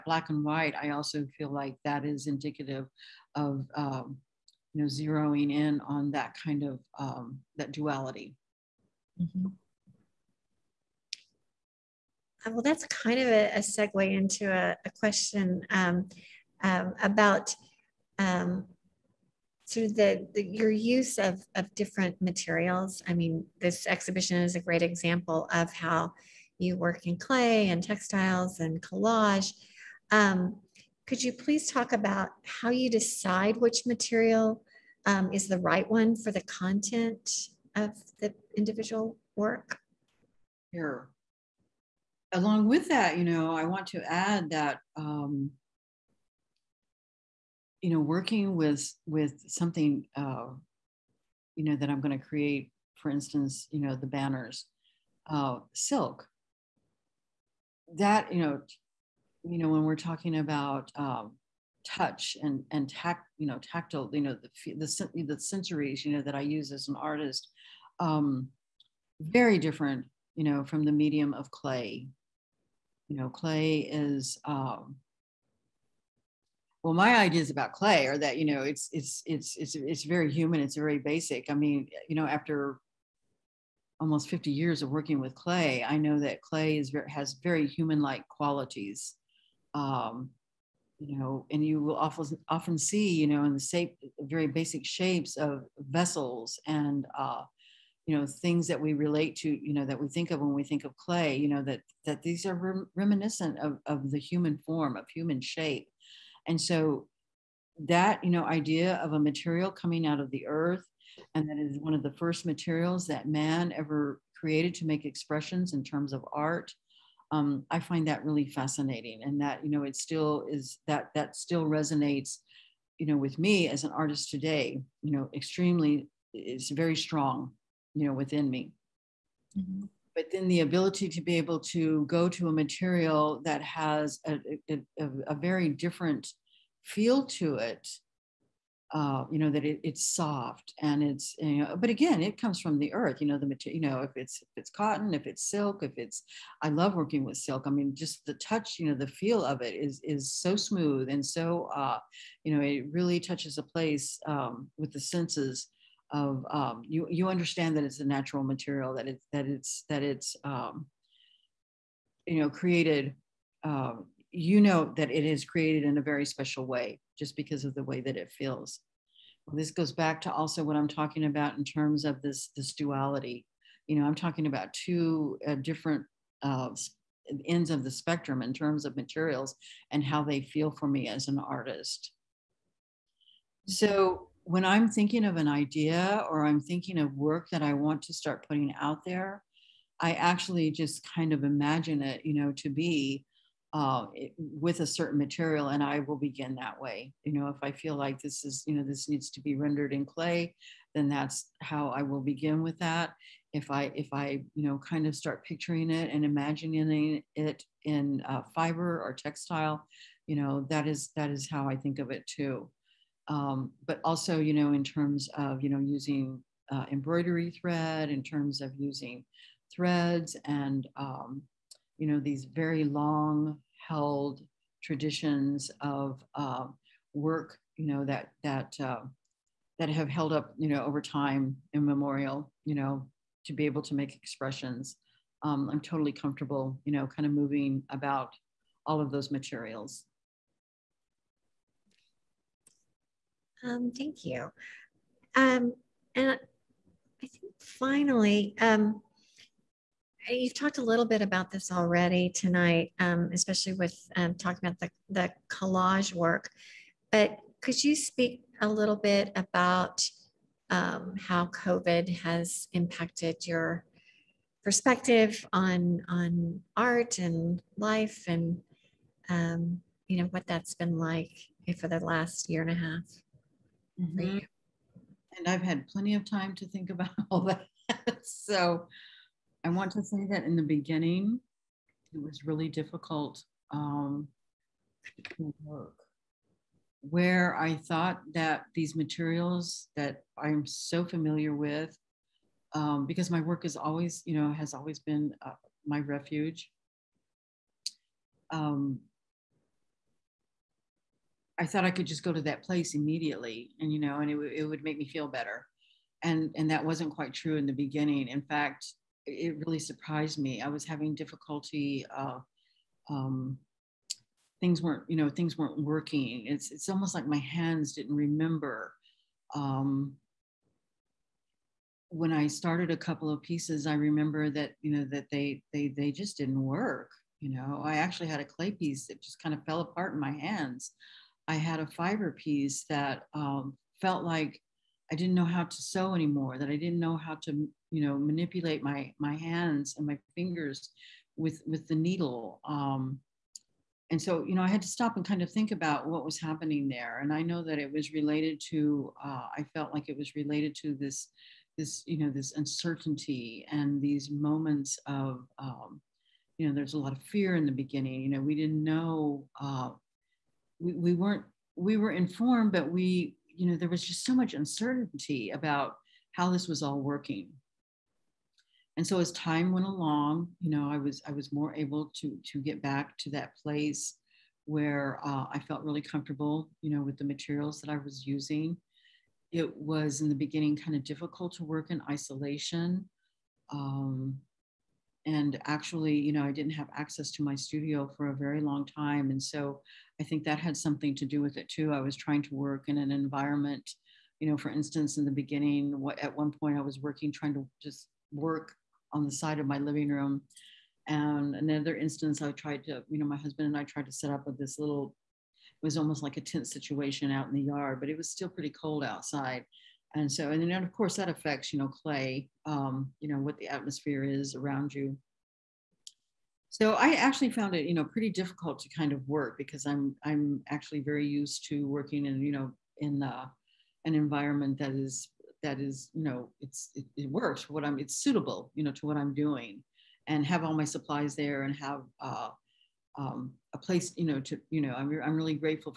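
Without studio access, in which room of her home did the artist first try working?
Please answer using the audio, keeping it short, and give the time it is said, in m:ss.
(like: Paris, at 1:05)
living room, at 6:39.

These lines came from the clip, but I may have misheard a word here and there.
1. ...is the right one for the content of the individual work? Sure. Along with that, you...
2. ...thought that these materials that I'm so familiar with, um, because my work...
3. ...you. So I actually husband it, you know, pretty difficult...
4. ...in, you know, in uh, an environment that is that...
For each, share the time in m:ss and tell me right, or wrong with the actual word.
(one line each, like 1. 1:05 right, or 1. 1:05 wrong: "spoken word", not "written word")
1. 0:35 right
2. 4:47 right
3. 6:54 wrong: "found", not "husband"
4. 7:02 right.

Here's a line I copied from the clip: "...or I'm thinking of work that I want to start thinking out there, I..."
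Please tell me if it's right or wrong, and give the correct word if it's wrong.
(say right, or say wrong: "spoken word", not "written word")
wrong: "putting", not "thinking".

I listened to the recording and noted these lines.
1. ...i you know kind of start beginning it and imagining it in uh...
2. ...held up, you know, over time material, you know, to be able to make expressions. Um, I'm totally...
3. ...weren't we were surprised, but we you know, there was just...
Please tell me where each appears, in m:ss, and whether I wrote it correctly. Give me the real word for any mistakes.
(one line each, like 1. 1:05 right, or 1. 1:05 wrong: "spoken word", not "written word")
1. 3:24 wrong: "picturing", not "beginning"
2. 3:50 wrong: "immemorial", not "material"
3. 6:01 wrong: "informed", not "surprised".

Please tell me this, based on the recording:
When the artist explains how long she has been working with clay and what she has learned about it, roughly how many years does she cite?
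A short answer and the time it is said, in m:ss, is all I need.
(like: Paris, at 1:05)
almost 50 years, at 1:23.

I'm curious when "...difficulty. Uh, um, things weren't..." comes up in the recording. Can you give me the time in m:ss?
5:11.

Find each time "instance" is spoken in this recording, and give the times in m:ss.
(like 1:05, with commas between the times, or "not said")
0:53, 6:34, 6:41.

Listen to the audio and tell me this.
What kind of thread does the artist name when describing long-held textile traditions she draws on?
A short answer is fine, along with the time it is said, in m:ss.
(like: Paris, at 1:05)
embroidery thread, at 3:36.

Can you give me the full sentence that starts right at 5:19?
Um, when I started a couple of pieces, I remember that you know that they they they just didn't work.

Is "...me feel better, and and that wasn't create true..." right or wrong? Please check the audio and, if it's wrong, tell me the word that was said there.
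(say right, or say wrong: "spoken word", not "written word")
wrong: "quite", not "create".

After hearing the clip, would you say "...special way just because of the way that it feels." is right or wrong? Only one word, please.
right.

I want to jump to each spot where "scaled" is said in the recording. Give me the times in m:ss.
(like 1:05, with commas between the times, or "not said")
not said.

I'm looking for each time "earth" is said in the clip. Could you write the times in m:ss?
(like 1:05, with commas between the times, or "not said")
1:50, 2:22.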